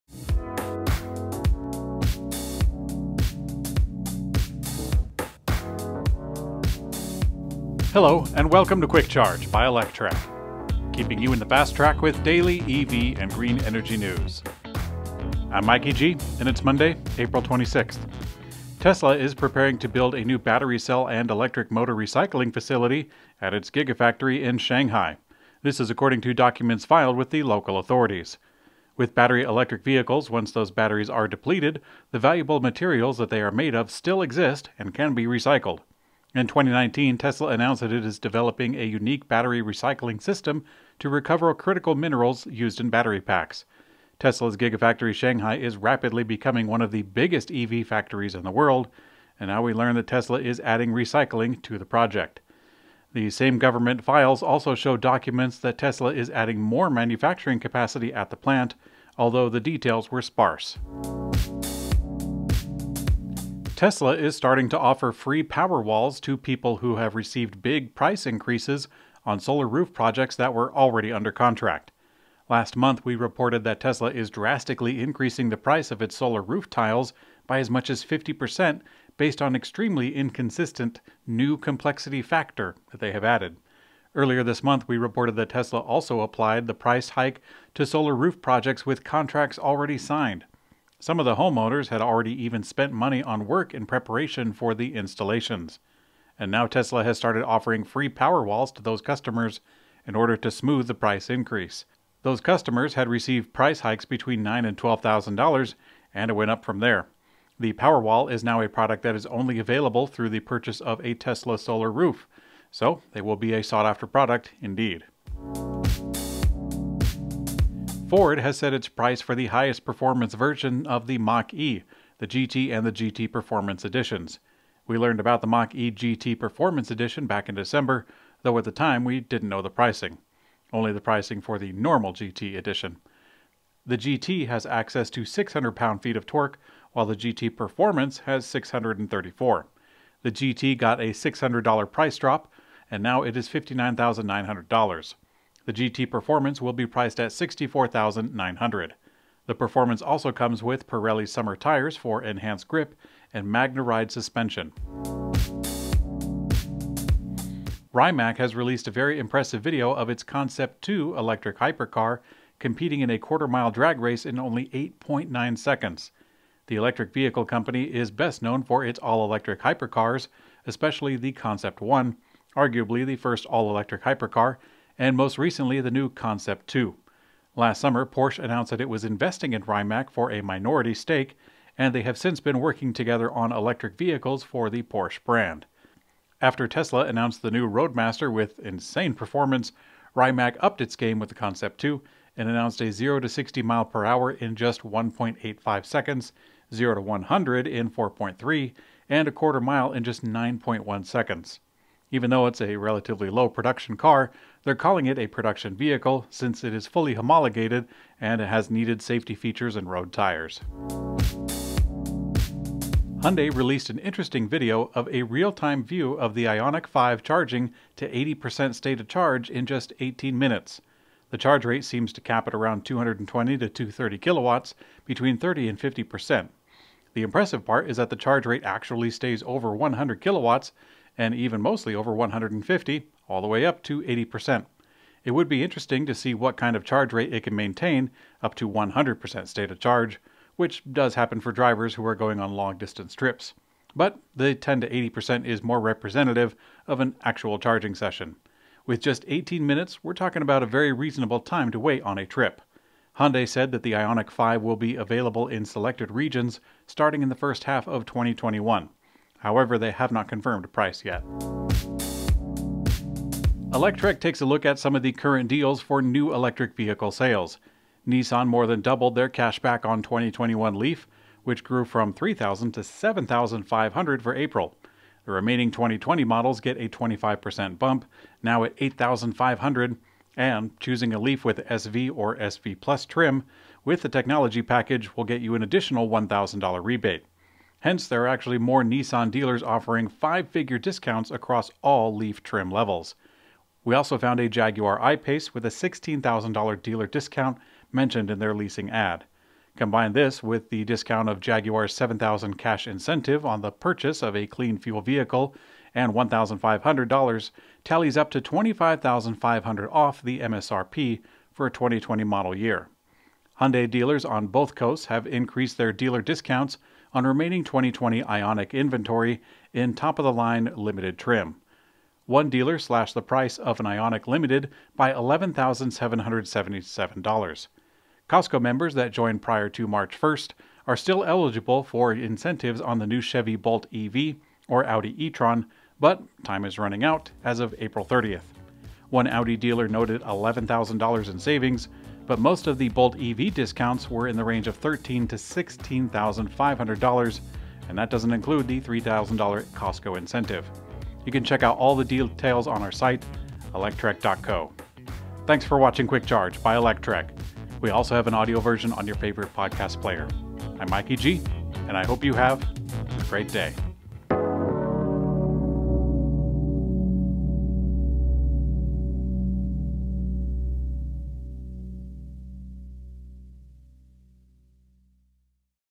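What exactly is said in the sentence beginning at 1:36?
And now Tesla has started offering free power walls to those customers in order to smooth the price increase.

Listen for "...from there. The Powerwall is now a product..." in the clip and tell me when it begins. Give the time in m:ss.
1:46.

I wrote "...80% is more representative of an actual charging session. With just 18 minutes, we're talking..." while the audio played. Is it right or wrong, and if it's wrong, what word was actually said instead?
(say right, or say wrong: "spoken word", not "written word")
right.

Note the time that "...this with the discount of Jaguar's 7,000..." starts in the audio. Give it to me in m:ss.
5:00.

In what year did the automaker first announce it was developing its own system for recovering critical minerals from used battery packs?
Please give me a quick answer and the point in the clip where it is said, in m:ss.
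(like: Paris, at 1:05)
2019, at 0:36.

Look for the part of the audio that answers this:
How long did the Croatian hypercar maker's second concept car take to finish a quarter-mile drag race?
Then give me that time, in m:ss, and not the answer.
2:44.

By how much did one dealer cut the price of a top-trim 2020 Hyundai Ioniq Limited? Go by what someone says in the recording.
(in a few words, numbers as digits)
$11,777.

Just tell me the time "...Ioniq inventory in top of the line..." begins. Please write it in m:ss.
5:18.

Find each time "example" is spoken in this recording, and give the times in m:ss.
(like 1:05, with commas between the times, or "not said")
not said.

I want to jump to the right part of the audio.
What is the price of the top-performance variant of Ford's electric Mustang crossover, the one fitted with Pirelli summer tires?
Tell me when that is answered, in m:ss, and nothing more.
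2:27.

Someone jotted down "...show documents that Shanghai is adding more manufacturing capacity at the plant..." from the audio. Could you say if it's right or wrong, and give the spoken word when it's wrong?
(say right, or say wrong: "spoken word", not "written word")
wrong: "Tesla", not "Shanghai".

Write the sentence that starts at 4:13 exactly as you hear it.
Hyundai said that the Ioniq 5 will be available in selected regions starting in the first half of 2021.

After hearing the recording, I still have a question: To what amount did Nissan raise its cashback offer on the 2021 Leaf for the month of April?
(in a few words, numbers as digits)
$7,500.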